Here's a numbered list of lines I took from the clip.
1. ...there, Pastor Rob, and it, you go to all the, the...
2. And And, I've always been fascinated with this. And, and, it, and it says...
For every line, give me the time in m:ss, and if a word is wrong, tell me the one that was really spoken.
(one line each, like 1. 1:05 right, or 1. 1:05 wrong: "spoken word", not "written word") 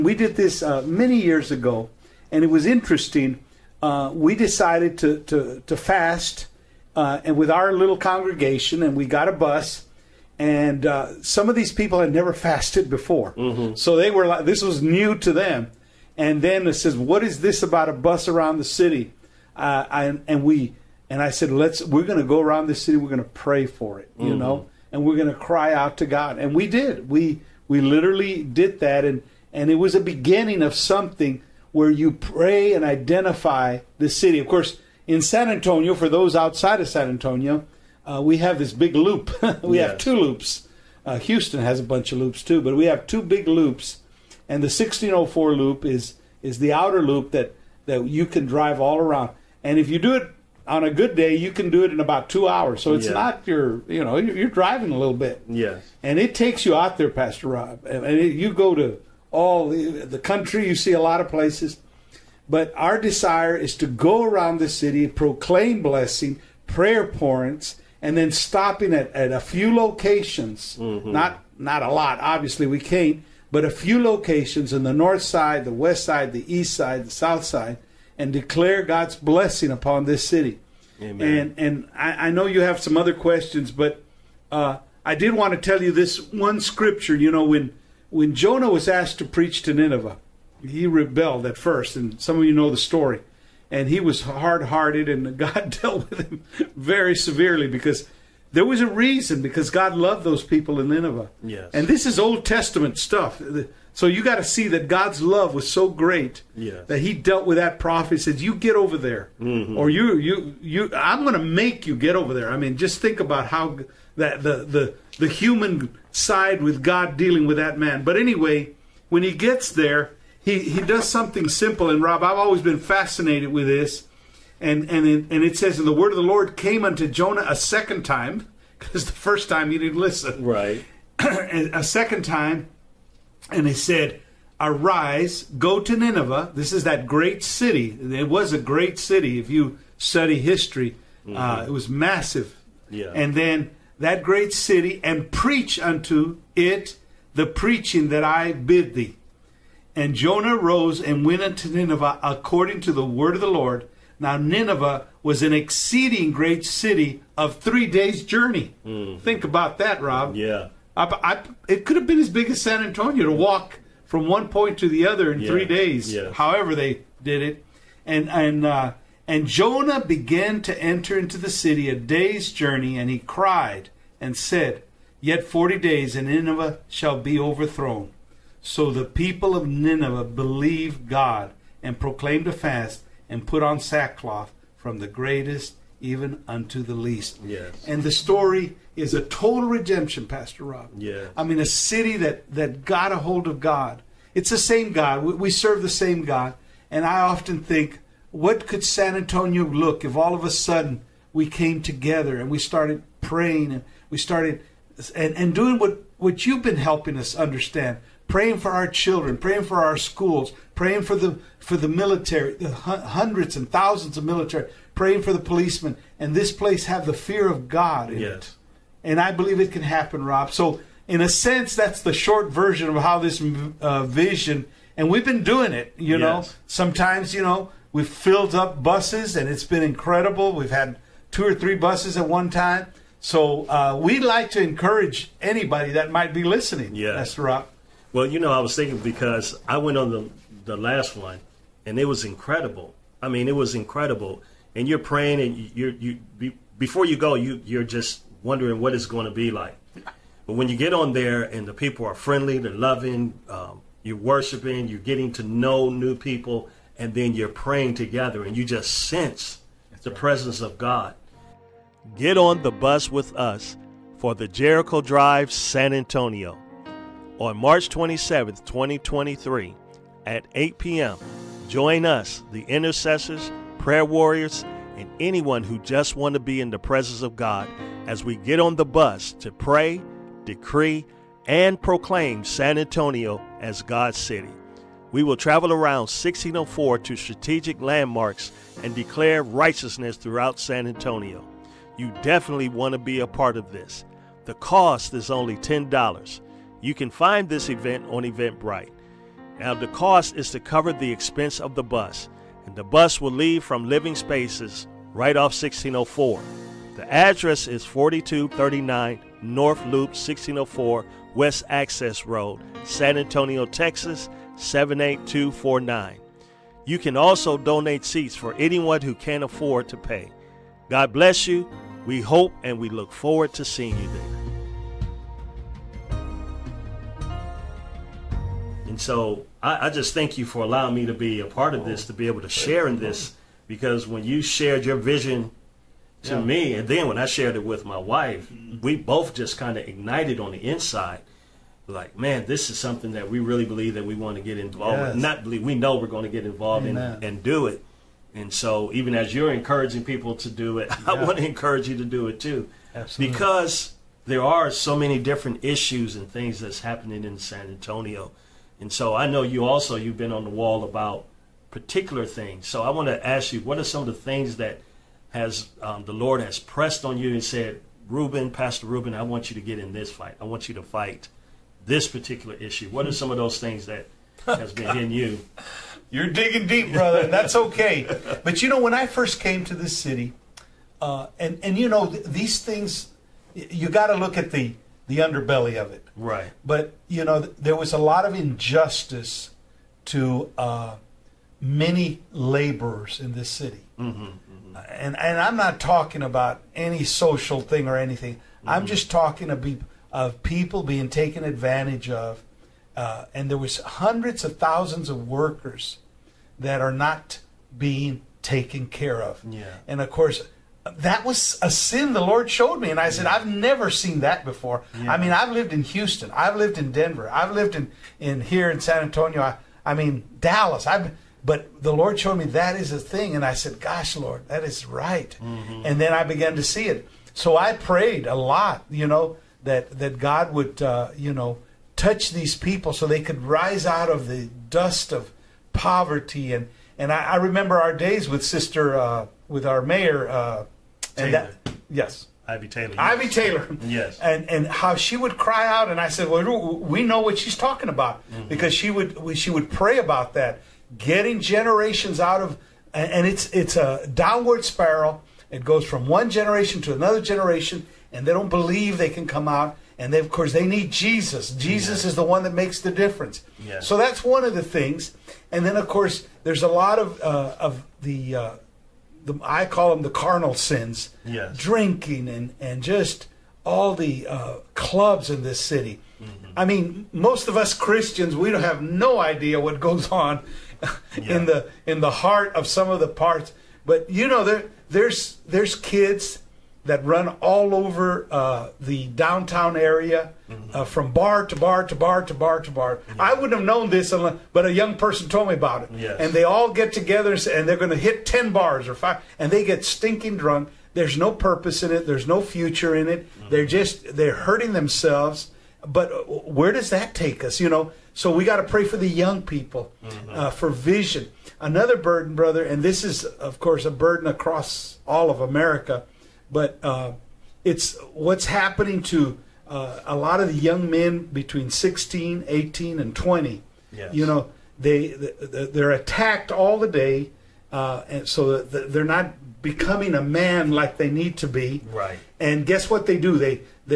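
1. 0:56 right
2. 2:01 wrong: "Rob", not "And".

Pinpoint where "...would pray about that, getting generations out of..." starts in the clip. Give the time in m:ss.
7:29.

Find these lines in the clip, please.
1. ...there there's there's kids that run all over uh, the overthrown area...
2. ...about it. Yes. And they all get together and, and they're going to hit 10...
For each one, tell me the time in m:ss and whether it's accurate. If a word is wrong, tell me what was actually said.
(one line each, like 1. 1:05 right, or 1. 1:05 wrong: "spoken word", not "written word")
1. 8:04 wrong: "downtown", not "overthrown"
2. 8:15 right.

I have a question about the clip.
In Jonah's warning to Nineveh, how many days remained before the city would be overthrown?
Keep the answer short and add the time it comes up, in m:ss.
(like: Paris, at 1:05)
40, at 2:55.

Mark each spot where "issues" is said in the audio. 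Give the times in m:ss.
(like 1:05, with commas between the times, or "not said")
5:55, 6:12.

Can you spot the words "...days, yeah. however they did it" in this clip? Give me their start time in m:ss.
2:45.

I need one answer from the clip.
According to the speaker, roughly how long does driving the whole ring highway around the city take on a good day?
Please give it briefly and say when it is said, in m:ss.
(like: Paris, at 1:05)
2 hours, at 0:51.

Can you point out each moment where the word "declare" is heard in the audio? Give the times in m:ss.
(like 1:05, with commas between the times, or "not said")
1:18, 4:48.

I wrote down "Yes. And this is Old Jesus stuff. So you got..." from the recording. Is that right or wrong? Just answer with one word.
wrong.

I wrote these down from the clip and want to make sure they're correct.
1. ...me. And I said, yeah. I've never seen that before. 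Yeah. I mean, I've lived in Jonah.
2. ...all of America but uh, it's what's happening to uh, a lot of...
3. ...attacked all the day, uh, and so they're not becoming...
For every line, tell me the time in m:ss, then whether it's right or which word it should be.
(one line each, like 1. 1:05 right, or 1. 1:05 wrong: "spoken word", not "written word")
1. 6:52 wrong: "Houston", not "Jonah"
2. 8:35 right
3. 8:45 right.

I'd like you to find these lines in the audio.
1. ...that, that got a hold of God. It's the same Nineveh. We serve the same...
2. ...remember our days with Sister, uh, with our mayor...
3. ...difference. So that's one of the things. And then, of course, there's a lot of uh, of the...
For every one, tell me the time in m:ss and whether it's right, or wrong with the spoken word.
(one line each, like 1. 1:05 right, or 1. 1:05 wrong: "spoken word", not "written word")
1. 3:12 wrong: "God", not "Nineveh"
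2. 7:17 right
3. 7:42 right.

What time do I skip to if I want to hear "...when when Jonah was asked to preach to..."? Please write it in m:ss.
1:27.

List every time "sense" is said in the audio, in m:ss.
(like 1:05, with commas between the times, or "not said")
3:41, 4:18.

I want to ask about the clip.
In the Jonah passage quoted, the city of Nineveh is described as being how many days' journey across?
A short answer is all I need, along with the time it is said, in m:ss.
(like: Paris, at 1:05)
3 days, at 2:37.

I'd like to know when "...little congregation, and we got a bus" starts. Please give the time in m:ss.
0:07.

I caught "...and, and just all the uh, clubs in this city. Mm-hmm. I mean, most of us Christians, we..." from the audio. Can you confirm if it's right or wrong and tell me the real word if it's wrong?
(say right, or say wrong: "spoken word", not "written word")
right.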